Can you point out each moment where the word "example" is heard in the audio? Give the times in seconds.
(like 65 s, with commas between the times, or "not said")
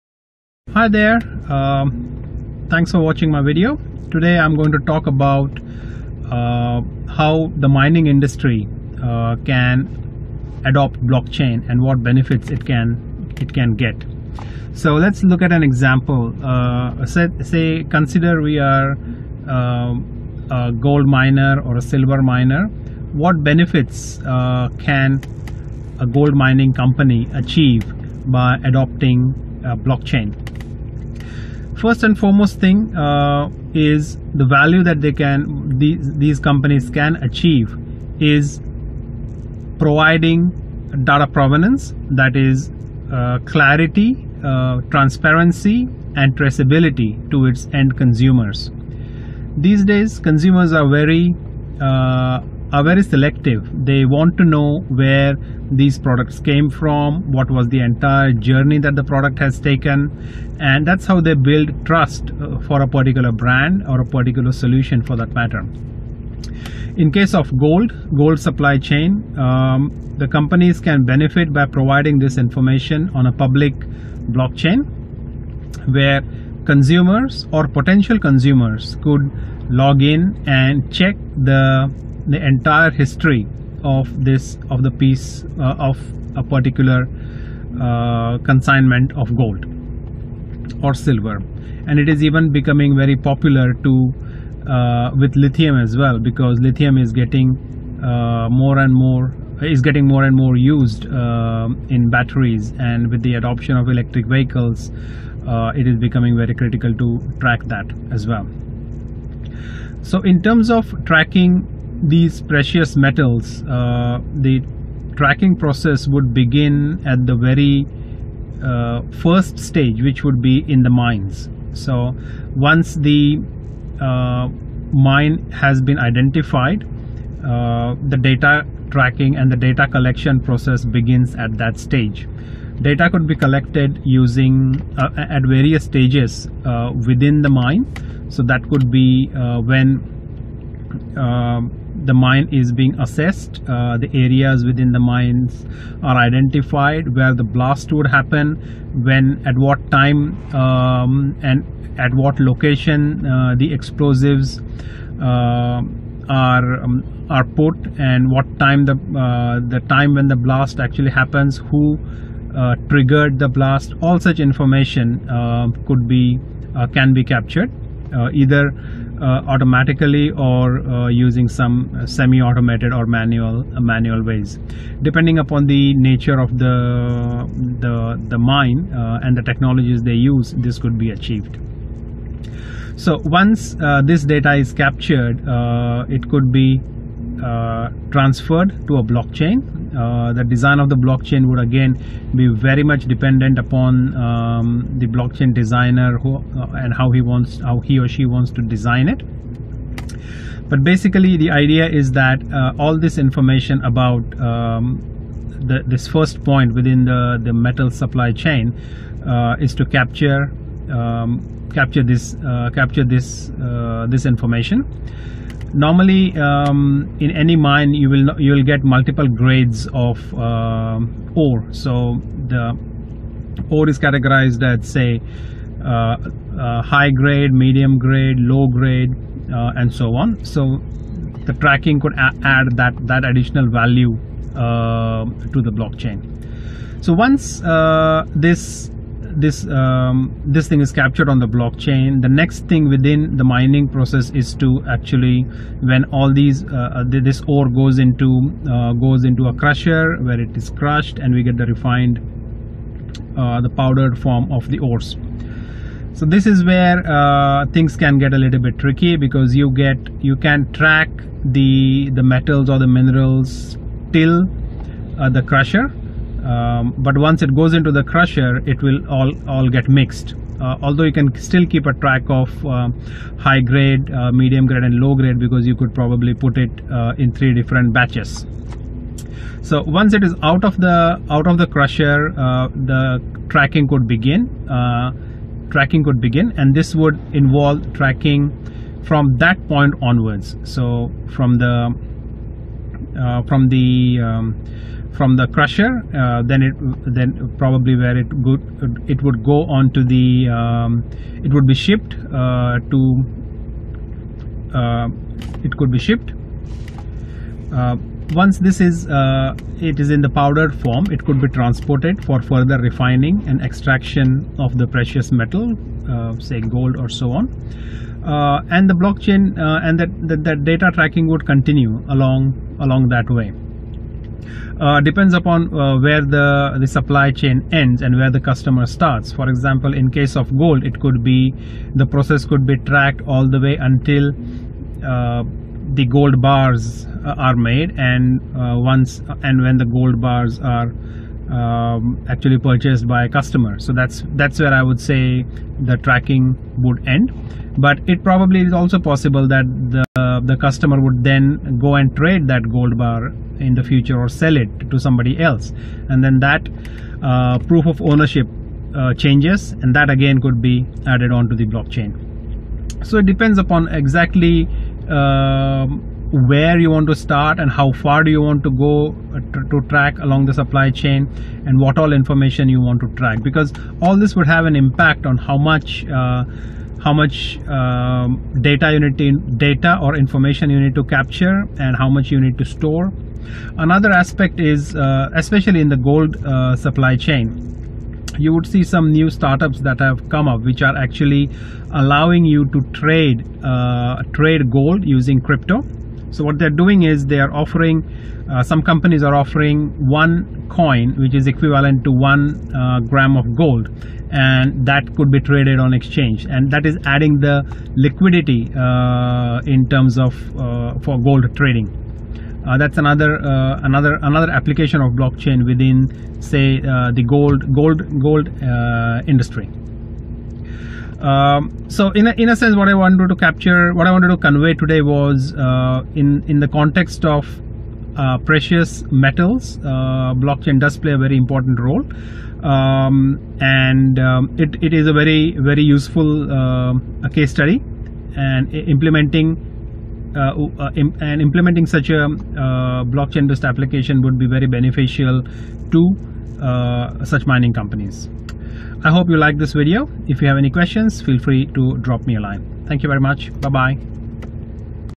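15 s, 329 s.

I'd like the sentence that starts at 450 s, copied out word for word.
If you have any questions, feel free to drop me a line.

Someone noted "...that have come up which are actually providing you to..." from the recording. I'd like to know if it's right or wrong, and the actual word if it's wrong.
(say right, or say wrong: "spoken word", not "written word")
wrong: "allowing", not "providing".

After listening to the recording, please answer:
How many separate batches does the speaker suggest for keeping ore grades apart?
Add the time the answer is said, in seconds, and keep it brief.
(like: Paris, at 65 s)
3, at 277 s.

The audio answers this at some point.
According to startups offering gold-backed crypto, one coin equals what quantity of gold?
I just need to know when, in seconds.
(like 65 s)
402 s.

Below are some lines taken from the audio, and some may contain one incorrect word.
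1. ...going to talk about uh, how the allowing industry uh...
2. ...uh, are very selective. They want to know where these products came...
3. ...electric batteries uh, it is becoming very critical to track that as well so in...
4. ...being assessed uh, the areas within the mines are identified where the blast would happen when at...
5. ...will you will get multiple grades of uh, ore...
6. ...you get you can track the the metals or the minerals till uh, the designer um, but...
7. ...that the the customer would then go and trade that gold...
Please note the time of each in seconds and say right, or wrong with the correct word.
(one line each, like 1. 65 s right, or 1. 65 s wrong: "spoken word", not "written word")
1. 4 s wrong: "mining", not "allowing"
2. 51 s right
3. 103 s wrong: "vehicles", not "batteries"
4. 142 s right
5. 218 s right
6. 259 s wrong: "crusher", not "designer"
7. 349 s right.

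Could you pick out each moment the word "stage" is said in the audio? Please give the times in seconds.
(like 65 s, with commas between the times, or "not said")
119 s, 131 s, 135 s.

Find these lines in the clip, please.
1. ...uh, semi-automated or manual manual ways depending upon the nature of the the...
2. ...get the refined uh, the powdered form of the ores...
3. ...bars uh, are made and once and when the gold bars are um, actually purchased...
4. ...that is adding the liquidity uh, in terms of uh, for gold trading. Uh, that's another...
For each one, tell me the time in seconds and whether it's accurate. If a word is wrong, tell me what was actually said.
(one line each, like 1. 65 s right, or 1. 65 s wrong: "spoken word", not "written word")
1. 171 s right
2. 251 s right
3. 336 s right
4. 406 s right.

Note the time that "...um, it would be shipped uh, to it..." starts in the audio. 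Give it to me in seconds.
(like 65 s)
300 s.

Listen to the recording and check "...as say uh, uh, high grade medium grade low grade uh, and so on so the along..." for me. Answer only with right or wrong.
wrong.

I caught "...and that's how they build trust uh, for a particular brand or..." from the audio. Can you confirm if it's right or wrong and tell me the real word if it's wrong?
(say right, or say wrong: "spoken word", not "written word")
right.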